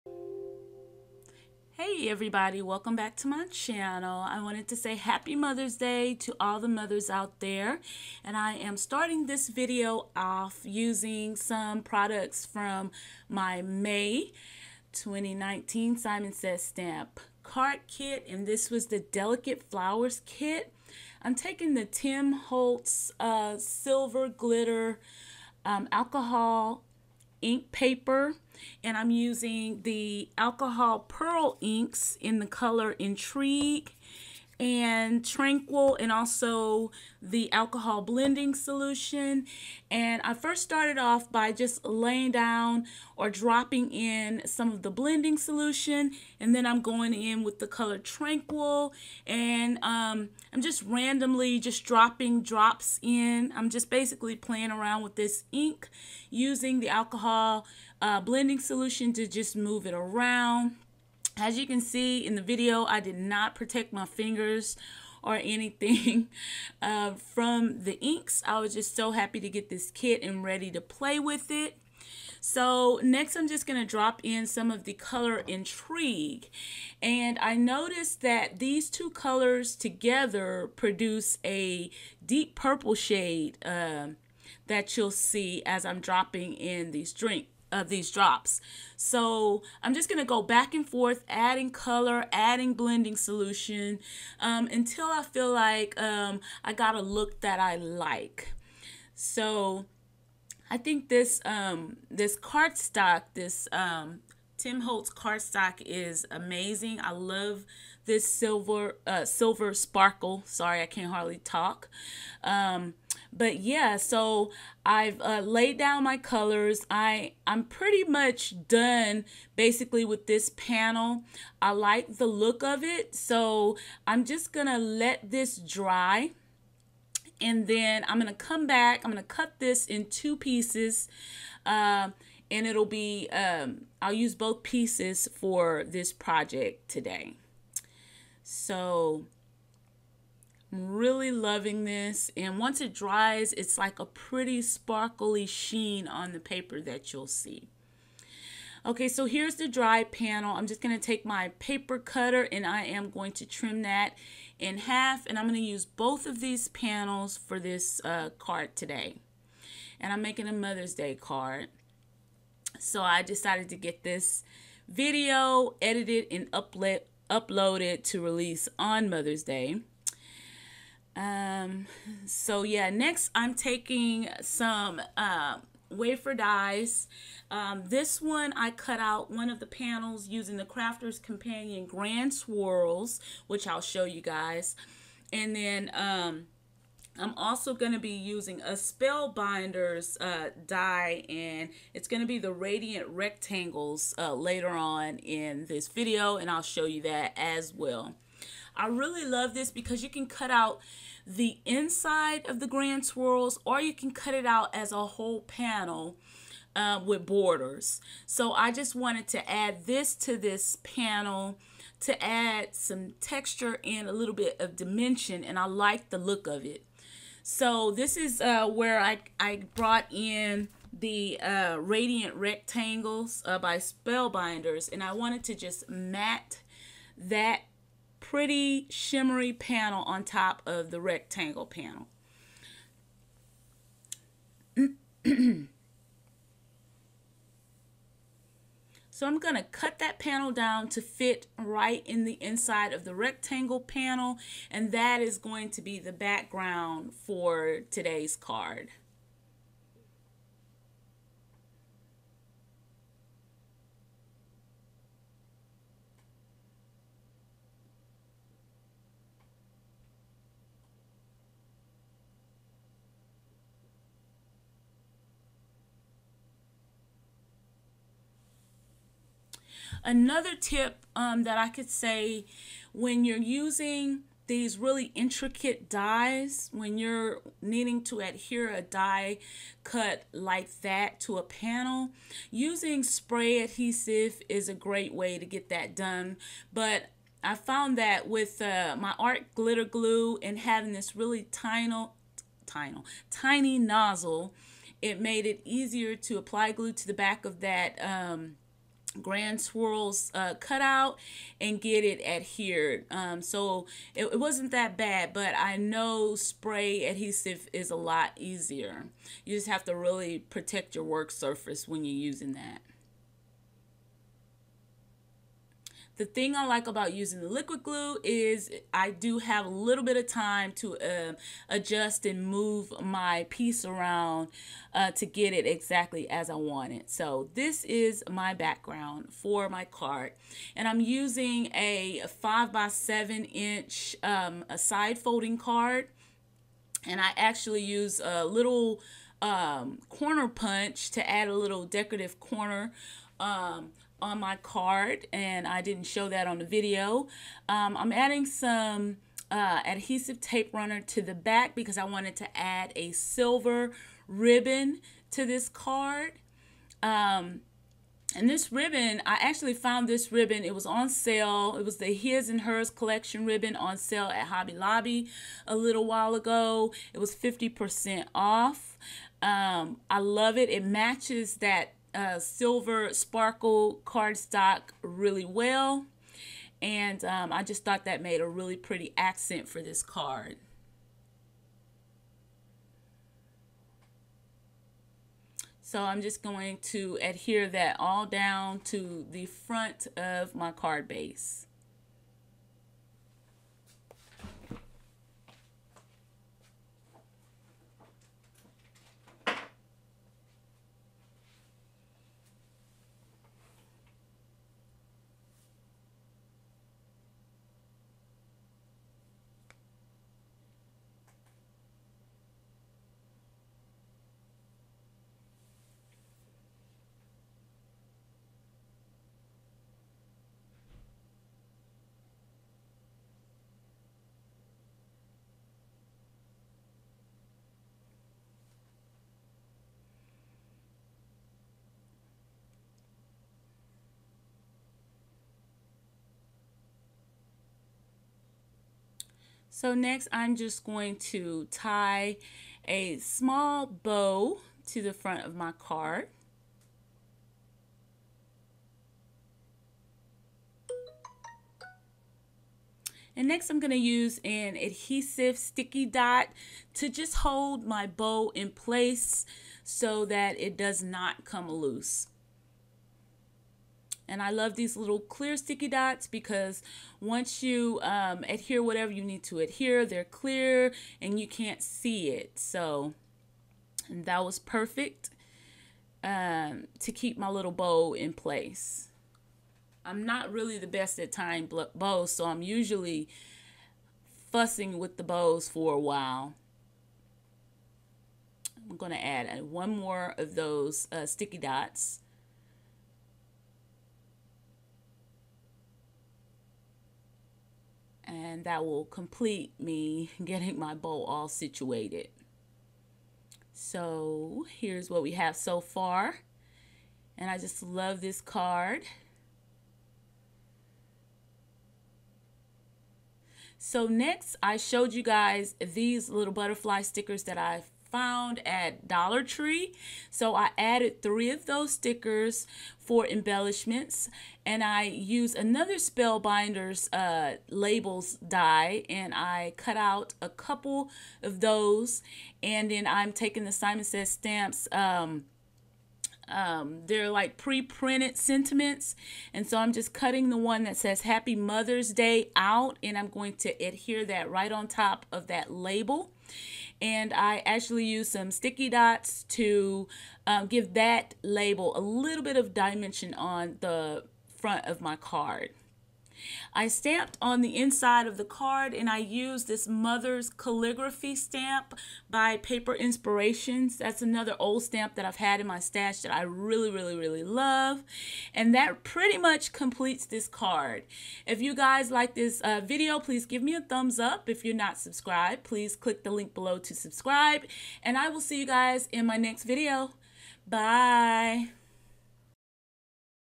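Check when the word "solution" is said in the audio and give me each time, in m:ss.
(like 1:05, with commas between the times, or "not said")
0:38, 0:45, 0:58, 1:33.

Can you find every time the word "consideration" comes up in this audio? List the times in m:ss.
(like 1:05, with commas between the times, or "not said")
not said.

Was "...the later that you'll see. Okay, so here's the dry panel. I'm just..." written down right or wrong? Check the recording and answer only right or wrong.
wrong.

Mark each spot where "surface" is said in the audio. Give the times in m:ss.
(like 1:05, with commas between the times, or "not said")
5:11.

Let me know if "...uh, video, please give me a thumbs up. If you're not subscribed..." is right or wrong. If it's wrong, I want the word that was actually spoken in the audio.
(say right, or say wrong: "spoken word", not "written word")
right.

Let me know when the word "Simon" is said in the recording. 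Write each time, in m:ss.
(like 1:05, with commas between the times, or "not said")
0:15, 8:53.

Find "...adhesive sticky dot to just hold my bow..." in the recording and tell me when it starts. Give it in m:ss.
7:34.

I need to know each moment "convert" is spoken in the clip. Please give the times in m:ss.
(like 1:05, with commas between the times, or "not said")
not said.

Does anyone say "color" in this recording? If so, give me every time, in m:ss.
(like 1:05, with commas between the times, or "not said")
0:32, 0:47, 1:14, 1:19, 1:31, 1:56.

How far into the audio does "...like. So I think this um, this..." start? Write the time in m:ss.
1:37.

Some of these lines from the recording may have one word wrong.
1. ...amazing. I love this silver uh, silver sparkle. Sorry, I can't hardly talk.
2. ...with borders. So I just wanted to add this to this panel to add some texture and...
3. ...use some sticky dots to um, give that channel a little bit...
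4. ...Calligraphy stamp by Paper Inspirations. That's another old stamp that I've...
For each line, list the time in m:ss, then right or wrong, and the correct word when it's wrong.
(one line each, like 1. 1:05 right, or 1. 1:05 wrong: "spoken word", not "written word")
1. 1:46 right
2. 3:27 right
3. 9:08 wrong: "label", not "channel"
4. 9:20 right.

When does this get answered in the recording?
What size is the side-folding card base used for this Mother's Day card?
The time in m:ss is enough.
5:32.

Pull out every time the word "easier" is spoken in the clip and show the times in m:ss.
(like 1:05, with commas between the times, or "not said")
4:55, 5:08.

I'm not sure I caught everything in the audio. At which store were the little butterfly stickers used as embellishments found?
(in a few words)
Dollar Tree.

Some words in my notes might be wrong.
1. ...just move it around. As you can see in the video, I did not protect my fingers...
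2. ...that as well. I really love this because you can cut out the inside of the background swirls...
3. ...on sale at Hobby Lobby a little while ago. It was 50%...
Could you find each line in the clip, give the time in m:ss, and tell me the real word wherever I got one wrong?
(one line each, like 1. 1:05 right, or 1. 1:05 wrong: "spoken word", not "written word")
1. 0:59 right
2. 3:17 wrong: "grand", not "background"
3. 6:03 right.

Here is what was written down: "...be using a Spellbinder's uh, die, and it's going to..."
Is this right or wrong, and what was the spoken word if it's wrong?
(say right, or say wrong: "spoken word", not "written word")
right.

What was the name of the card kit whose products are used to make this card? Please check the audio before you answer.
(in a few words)
Delicate Flowers.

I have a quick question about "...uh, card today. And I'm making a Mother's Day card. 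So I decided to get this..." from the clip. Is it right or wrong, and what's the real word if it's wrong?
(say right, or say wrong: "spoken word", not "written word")
right.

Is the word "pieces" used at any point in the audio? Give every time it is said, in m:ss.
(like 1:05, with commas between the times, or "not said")
2:10, 2:14, 5:23.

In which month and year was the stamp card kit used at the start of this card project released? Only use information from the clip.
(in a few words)
May 2019.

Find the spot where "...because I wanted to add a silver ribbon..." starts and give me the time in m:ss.
5:51.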